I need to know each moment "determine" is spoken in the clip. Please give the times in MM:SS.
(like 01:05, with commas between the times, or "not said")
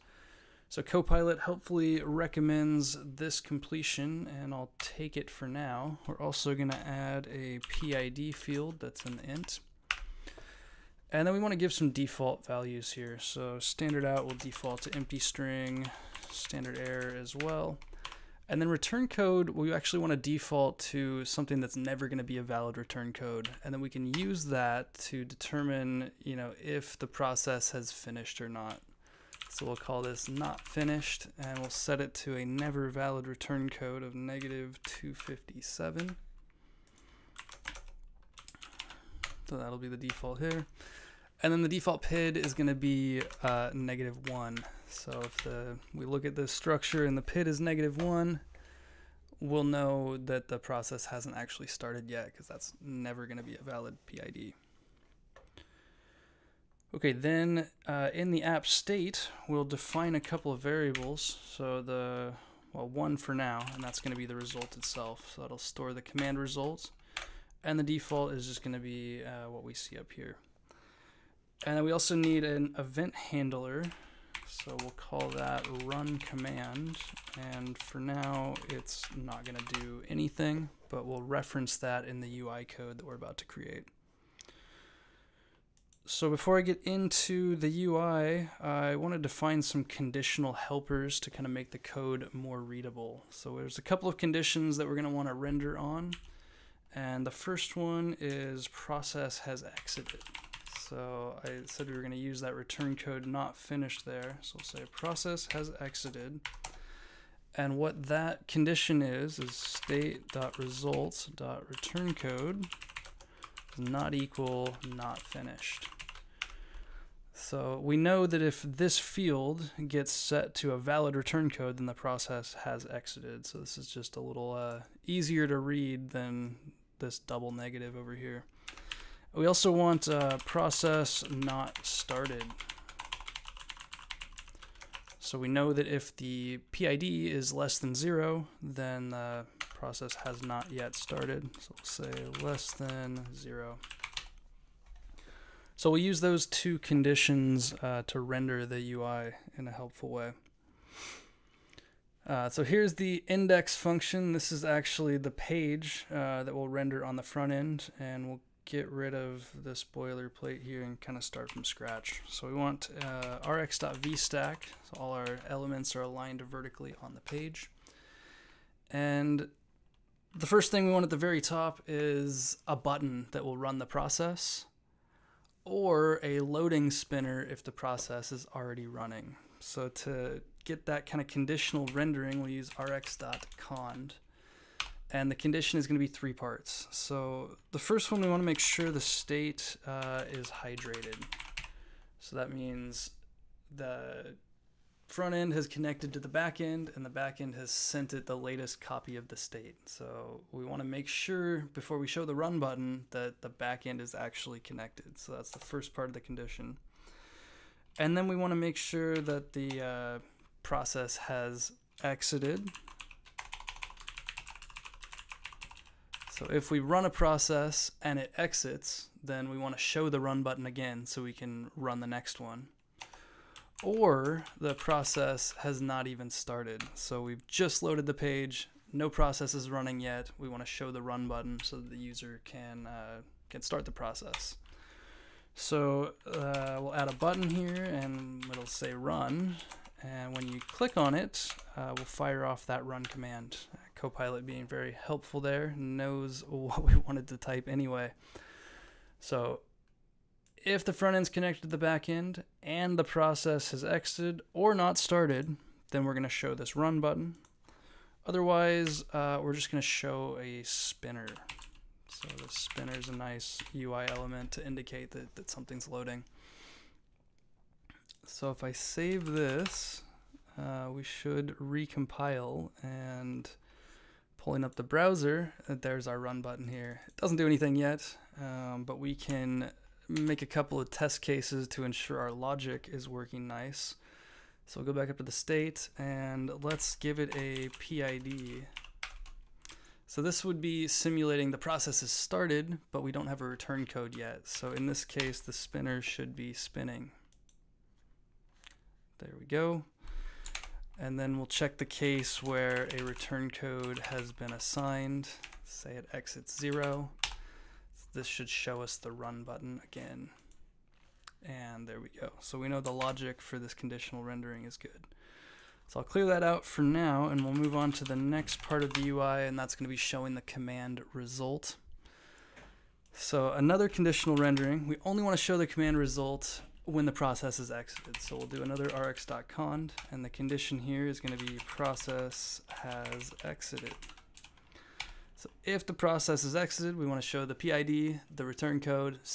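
00:25.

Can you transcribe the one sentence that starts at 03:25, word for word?
So that's the first part of the condition.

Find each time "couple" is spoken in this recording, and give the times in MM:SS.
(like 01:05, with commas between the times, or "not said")
01:00, 01:33, 04:40.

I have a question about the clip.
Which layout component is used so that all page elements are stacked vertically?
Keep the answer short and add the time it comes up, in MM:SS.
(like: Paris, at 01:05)
rx.vstack, at 02:43.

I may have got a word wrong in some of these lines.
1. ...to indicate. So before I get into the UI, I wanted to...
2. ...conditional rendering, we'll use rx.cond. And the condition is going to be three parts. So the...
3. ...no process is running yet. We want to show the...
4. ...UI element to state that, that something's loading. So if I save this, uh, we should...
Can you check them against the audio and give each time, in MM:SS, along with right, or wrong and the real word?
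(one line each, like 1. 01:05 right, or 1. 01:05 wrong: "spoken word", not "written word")
1. 01:23 wrong: "create", not "indicate"
2. 03:01 right
3. 03:48 right
4. 04:23 wrong: "indicate", not "state".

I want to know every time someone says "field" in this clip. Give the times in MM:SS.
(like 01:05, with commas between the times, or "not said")
00:08, 01:58.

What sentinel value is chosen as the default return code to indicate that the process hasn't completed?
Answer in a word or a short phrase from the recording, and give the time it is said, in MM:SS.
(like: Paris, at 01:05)
-257, at 00:34.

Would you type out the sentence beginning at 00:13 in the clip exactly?
So standard out will default to empty string, standard error as well.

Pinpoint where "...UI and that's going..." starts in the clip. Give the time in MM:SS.
05:19.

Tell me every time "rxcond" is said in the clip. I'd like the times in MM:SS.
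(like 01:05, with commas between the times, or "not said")
03:02, 05:28.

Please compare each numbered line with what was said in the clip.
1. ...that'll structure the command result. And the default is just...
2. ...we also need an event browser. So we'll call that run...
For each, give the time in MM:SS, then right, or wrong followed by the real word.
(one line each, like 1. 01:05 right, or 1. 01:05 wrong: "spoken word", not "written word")
1. 01:05 wrong: "store", not "structure"
2. 01:11 wrong: "handler", not "browser".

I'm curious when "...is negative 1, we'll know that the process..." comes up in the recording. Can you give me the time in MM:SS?
00:47.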